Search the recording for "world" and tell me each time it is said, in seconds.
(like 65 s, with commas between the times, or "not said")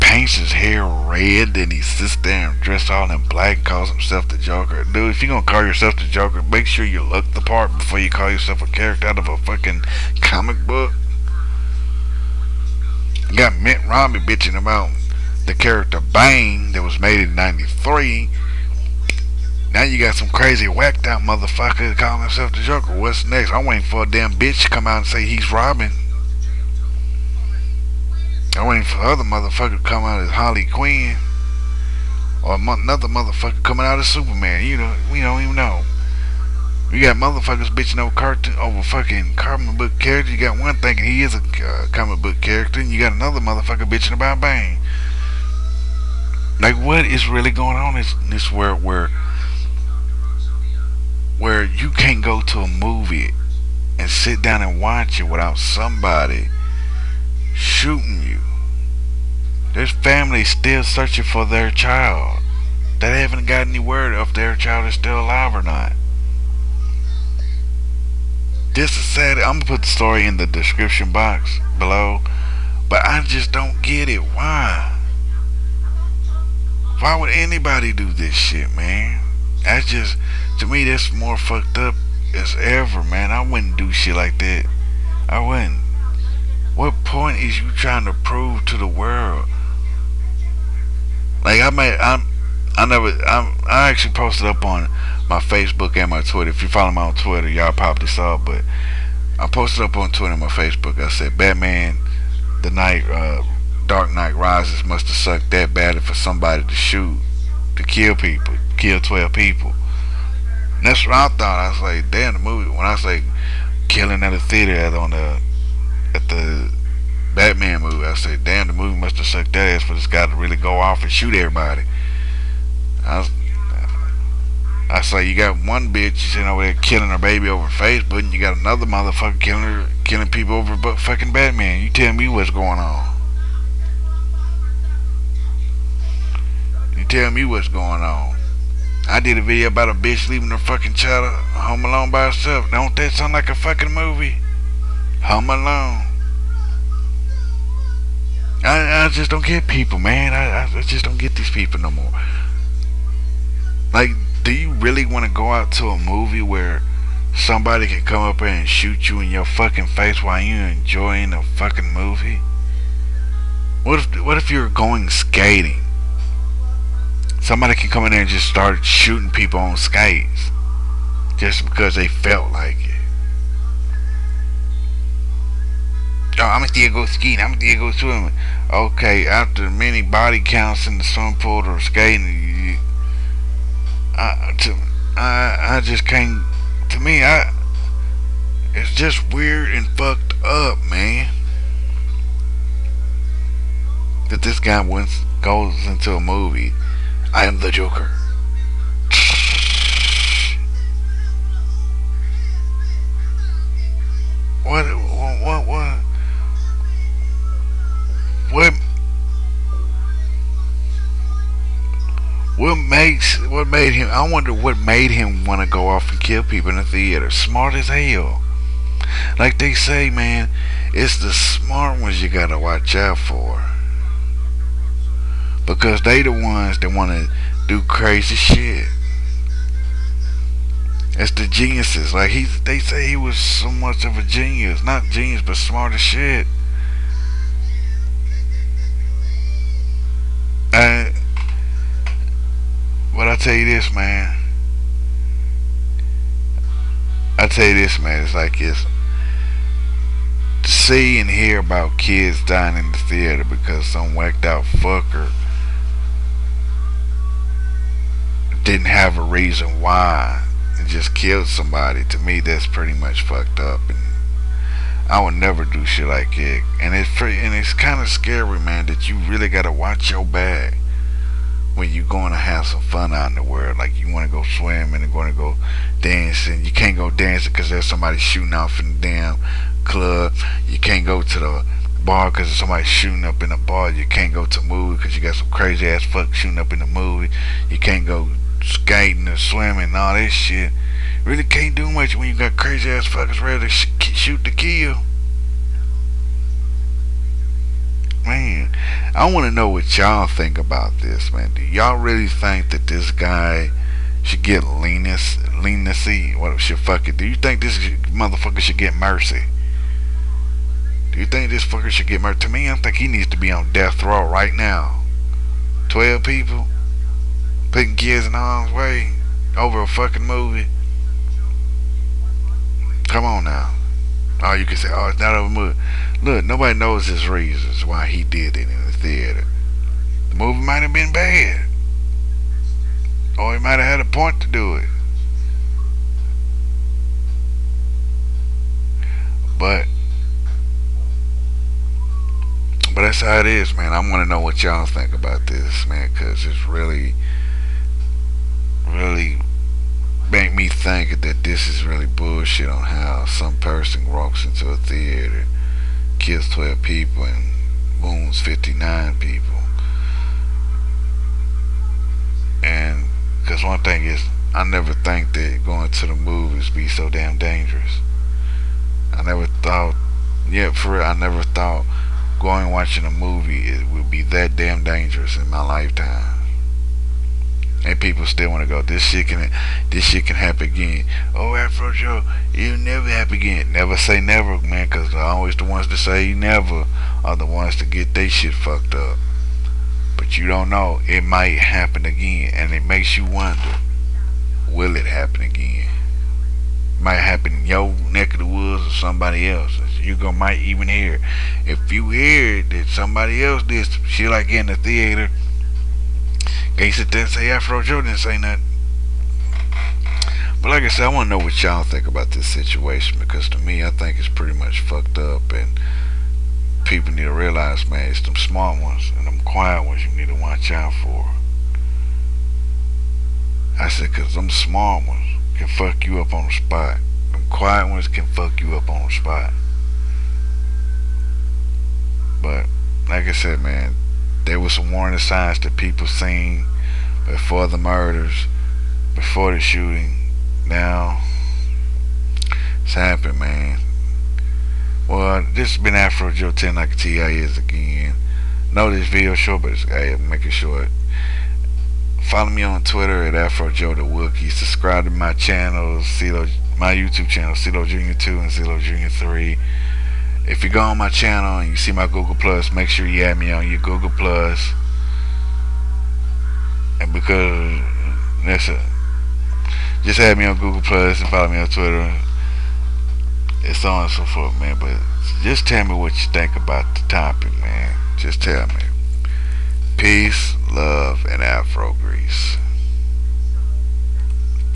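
48 s, 88 s, 273 s.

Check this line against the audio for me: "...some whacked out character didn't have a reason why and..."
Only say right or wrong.
wrong.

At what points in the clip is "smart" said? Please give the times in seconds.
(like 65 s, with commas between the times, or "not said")
217 s, 221 s, 235 s, 418 s, 424 s.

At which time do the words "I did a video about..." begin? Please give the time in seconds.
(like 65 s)
139 s.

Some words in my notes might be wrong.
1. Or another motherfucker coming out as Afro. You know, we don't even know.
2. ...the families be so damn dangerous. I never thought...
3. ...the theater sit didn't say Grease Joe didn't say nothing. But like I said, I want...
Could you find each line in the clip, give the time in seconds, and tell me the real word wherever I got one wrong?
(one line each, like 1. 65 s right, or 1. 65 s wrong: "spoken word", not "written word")
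1. 32 s wrong: "Superman", not "Afro"
2. 366 s wrong: "movies", not "families"
3. 404 s wrong: "Afro", not "Grease".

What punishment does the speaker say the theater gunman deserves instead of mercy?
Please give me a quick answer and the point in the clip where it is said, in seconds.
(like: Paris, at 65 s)
Death row, at 313 s.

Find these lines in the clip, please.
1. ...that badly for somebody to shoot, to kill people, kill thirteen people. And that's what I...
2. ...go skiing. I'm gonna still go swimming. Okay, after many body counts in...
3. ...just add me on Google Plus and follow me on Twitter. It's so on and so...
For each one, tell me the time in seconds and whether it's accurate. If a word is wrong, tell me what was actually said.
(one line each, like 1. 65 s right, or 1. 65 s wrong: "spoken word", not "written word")
1. 105 s wrong: "twelve", not "thirteen"
2. 176 s right
3. 470 s right.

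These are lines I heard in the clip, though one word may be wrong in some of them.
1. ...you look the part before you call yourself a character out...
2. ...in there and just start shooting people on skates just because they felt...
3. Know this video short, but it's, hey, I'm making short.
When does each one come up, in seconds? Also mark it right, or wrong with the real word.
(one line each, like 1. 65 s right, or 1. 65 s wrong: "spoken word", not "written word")
1. 6 s right
2. 168 s right
3. 448 s right.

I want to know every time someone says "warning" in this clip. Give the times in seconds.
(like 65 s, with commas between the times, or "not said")
434 s.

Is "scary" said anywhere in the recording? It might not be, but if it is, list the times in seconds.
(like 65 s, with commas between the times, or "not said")
268 s.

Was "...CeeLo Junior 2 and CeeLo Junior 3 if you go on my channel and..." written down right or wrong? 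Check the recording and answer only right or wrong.
right.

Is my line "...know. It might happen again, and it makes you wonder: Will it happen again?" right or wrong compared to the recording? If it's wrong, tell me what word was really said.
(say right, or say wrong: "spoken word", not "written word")
right.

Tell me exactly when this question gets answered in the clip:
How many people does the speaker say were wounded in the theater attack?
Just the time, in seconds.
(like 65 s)
358 s.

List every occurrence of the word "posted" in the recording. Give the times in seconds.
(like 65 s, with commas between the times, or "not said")
94 s, 99 s.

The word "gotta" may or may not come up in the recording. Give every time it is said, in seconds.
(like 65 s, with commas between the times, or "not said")
222 s, 269 s.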